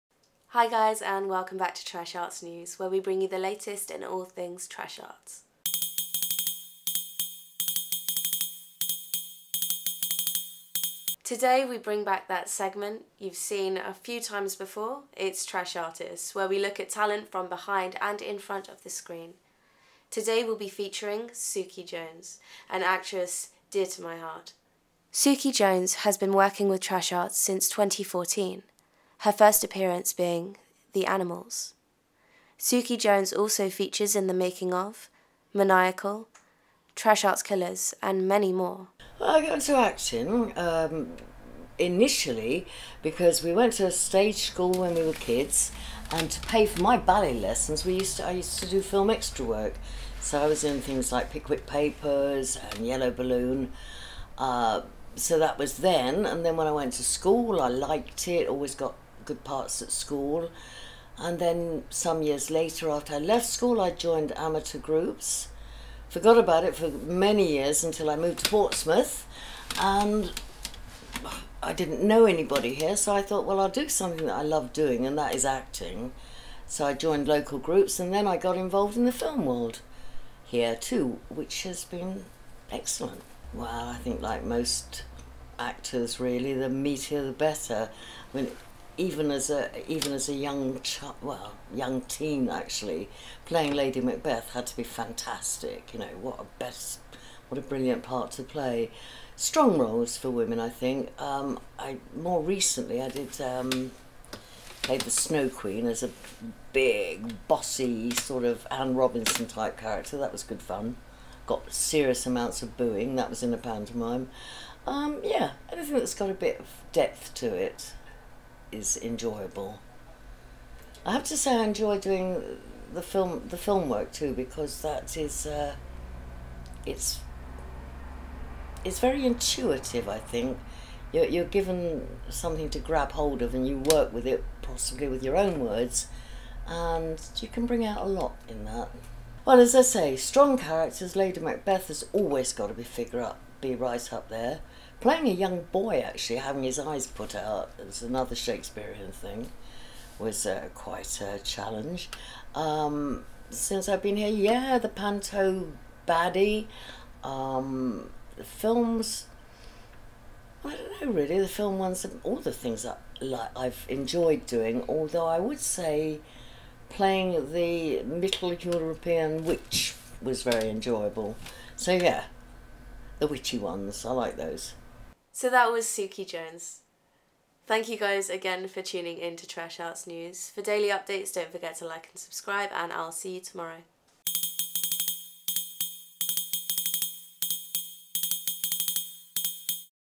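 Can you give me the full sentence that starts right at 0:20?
Today we'll be featuring Suki Jones, an actress dear to my heart.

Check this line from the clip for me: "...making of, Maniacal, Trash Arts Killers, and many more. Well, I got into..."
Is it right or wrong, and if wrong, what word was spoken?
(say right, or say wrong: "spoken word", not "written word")
right.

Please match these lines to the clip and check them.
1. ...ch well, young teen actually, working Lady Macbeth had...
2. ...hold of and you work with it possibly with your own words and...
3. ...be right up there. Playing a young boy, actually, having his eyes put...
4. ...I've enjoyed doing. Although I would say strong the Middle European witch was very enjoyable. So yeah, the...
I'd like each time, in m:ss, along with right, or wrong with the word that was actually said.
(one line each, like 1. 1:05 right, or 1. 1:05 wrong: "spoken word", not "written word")
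1. 1:30 wrong: "playing", not "working"
2. 2:13 right
3. 2:23 right
4. 2:43 wrong: "playing", not "strong".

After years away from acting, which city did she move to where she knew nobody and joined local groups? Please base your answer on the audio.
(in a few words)
Portsmouth.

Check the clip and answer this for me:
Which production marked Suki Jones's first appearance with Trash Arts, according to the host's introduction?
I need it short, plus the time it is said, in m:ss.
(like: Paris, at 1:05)
The Animals, at 0:30.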